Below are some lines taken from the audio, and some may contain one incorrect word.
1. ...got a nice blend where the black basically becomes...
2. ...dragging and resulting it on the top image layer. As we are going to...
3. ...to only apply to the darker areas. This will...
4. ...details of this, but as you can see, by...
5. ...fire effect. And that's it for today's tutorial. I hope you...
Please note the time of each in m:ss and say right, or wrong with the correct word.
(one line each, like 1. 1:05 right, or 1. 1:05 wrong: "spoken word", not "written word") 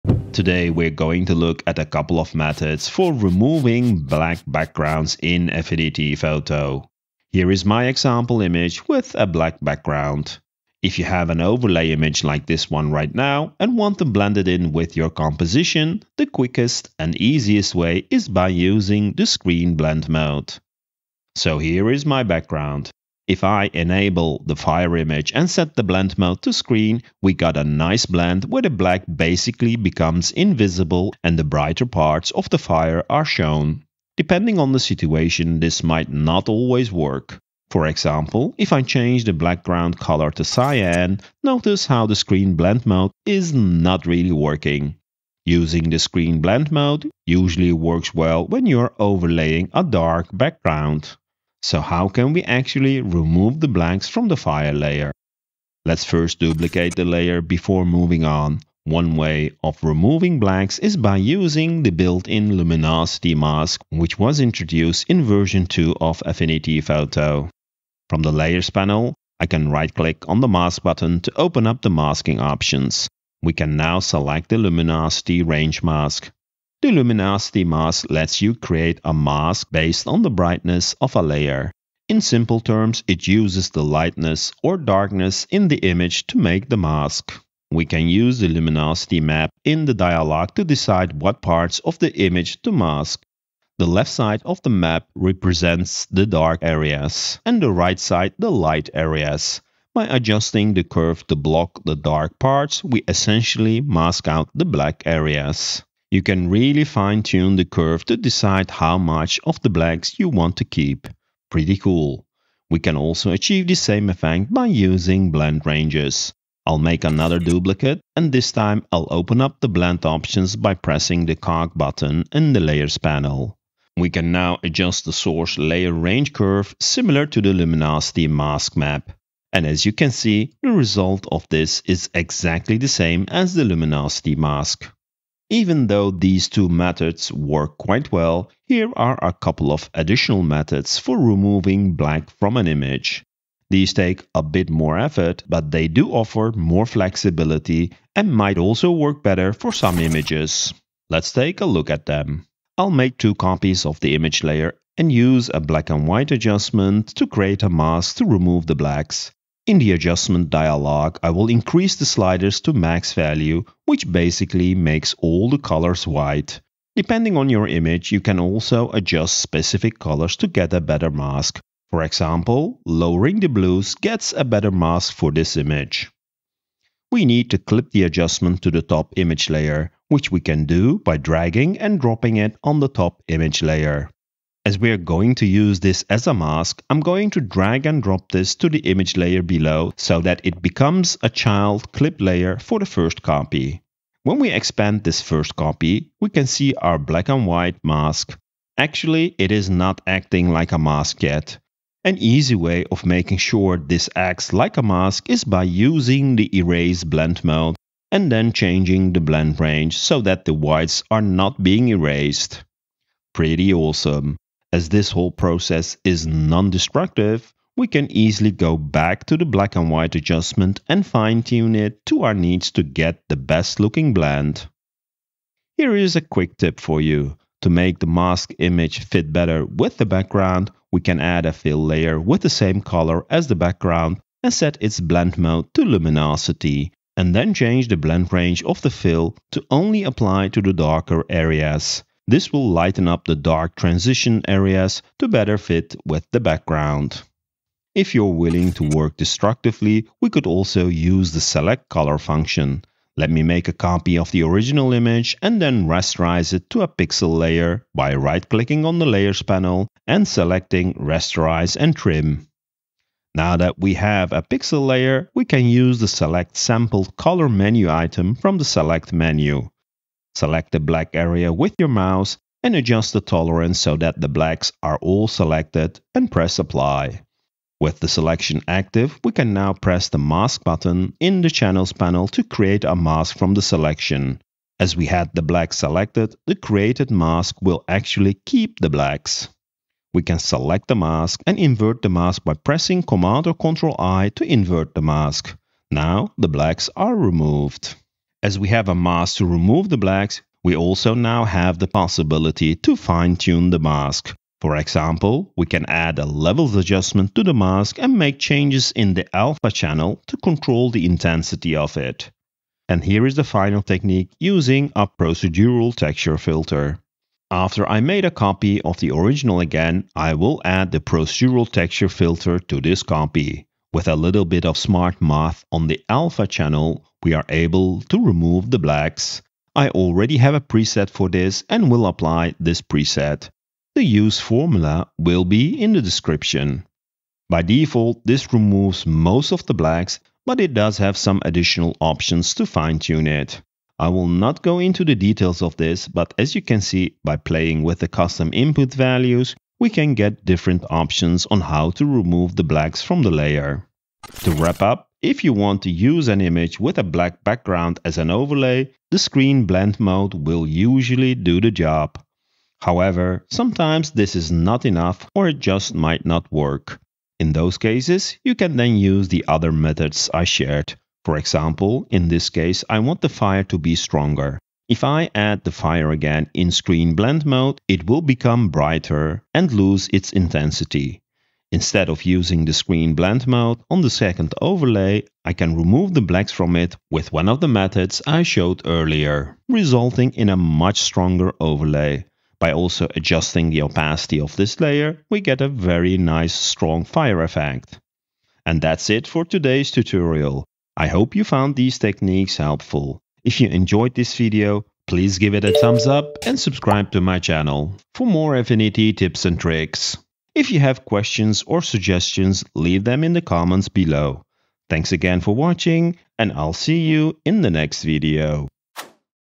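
1. 0:27 right
2. 3:01 wrong: "dropping", not "resulting"
3. 3:59 right
4. 5:45 right
5. 6:37 right.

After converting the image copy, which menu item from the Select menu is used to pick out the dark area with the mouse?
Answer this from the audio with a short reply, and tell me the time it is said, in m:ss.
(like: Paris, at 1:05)
Select Sampled Color, at 4:26.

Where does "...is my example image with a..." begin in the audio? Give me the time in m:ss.
0:07.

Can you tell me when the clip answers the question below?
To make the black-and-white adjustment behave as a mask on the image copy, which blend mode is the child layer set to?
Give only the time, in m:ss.
3:26.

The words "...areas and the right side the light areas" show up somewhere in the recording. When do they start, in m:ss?
1:36.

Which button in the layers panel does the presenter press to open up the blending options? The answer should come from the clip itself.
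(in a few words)
The cog button.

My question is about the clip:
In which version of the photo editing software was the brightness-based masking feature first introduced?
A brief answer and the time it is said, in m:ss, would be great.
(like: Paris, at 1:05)
Version 2, at 1:05.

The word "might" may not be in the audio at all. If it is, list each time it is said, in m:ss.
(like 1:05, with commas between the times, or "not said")
0:35, 2:28, 6:05.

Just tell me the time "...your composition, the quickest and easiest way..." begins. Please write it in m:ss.
0:14.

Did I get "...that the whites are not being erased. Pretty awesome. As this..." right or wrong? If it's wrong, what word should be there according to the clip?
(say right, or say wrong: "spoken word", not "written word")
right.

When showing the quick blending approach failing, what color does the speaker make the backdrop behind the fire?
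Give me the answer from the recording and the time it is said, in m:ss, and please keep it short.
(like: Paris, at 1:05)
Cyan, at 0:40.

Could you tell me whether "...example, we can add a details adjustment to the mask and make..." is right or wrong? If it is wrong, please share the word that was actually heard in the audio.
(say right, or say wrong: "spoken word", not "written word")
wrong: "levels", not "details".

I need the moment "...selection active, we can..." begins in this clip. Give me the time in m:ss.
4:38.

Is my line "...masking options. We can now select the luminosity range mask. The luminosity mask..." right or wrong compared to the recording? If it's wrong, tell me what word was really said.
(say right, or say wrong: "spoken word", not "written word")
right.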